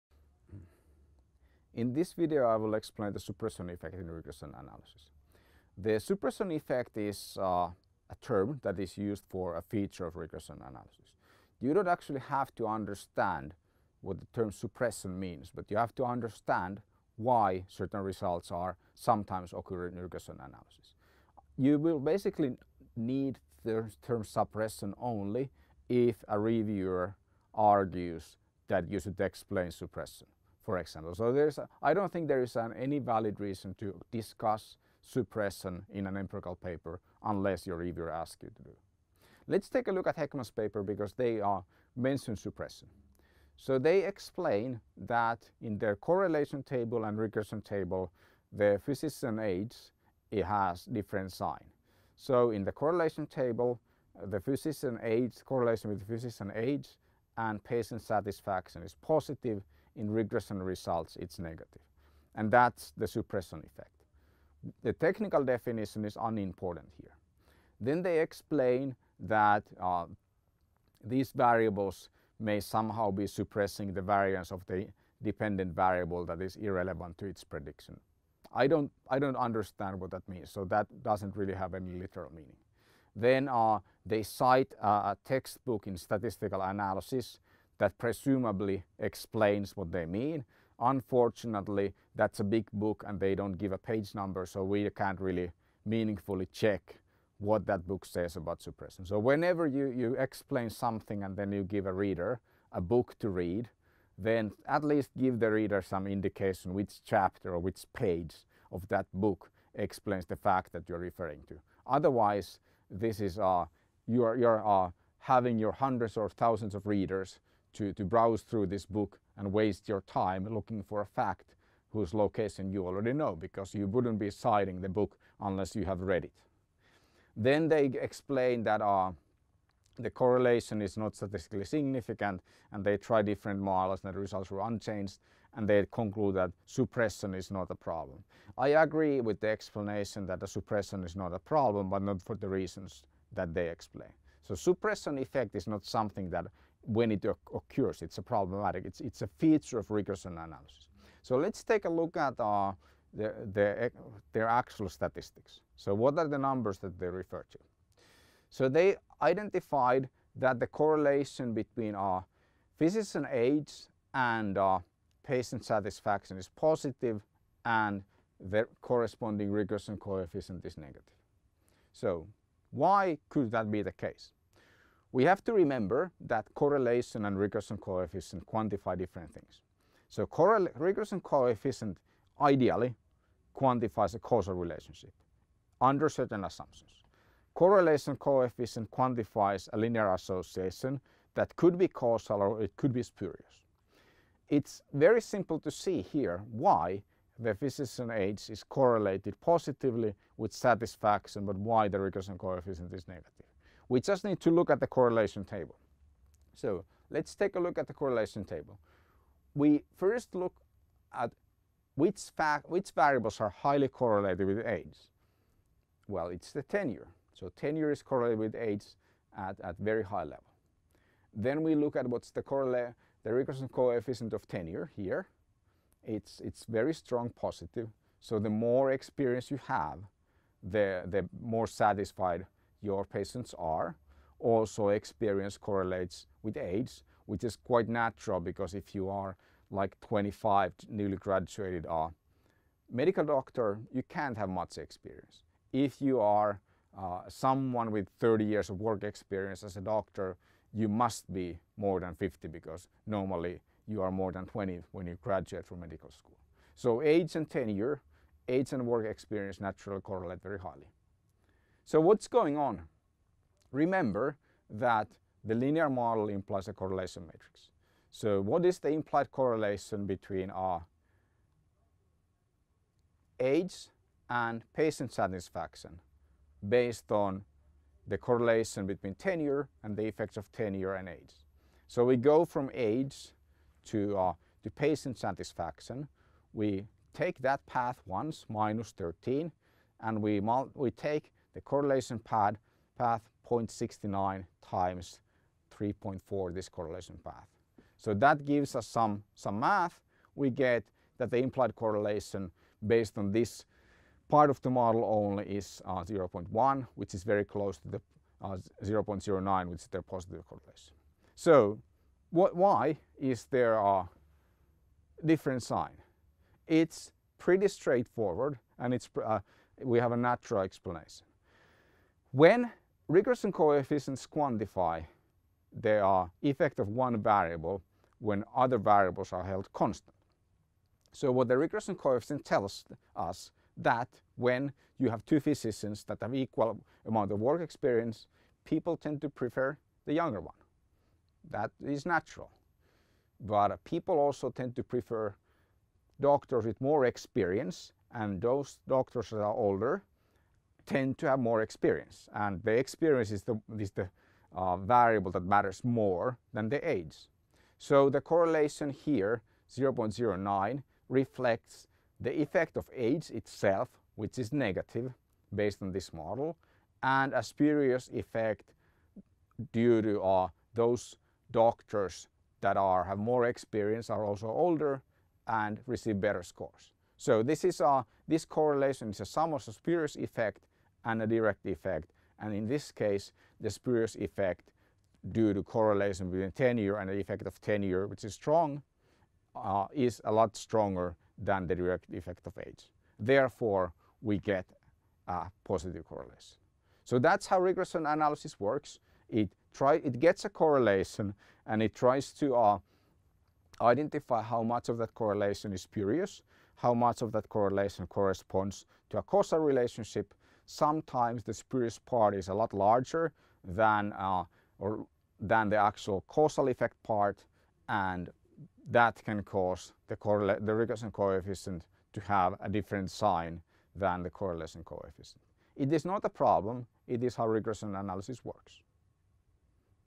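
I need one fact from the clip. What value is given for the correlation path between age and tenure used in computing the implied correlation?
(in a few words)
0.69.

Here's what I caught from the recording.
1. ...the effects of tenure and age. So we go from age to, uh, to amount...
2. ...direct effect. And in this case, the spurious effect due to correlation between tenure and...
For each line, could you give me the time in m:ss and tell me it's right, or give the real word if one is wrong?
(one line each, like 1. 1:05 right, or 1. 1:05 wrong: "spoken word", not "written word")
1. 4:39 wrong: "patient", not "amount"
2. 6:21 right.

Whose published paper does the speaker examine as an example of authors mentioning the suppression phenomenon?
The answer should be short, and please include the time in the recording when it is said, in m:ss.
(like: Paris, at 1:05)
Hekman, at 0:40.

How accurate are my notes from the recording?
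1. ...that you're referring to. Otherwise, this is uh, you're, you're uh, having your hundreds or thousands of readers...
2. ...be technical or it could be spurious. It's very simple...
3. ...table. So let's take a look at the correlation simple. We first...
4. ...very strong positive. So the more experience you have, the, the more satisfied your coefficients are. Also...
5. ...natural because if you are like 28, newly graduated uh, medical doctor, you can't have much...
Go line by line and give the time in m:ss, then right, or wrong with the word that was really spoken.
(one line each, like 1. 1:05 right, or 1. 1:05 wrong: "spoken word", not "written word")
1. 1:50 right
2. 3:11 wrong: "causal", not "technical"
3. 3:25 wrong: "table", not "simple"
4. 3:46 wrong: "patients", not "coefficients"
5. 3:57 wrong: "25", not "28".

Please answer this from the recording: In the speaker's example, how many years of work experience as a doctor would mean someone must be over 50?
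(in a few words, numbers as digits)
30.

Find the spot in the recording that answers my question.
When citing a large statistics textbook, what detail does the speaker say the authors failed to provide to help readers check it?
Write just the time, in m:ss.
1:33.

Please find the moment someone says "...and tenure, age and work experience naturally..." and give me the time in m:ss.
4:17.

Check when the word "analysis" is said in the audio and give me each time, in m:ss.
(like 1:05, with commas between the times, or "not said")
0:04, 0:10, 0:20, 1:26, 2:30, 6:38, 7:07.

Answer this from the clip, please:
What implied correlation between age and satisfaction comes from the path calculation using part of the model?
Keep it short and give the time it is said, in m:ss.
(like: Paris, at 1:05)
0.1, at 5:06.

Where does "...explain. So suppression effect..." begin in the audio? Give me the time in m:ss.
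2:23.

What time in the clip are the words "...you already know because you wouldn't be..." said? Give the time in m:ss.
2:02.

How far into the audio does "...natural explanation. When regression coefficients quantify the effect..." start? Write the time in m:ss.
5:20.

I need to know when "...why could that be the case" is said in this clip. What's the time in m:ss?
2:52.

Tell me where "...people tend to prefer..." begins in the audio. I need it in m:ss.
5:38.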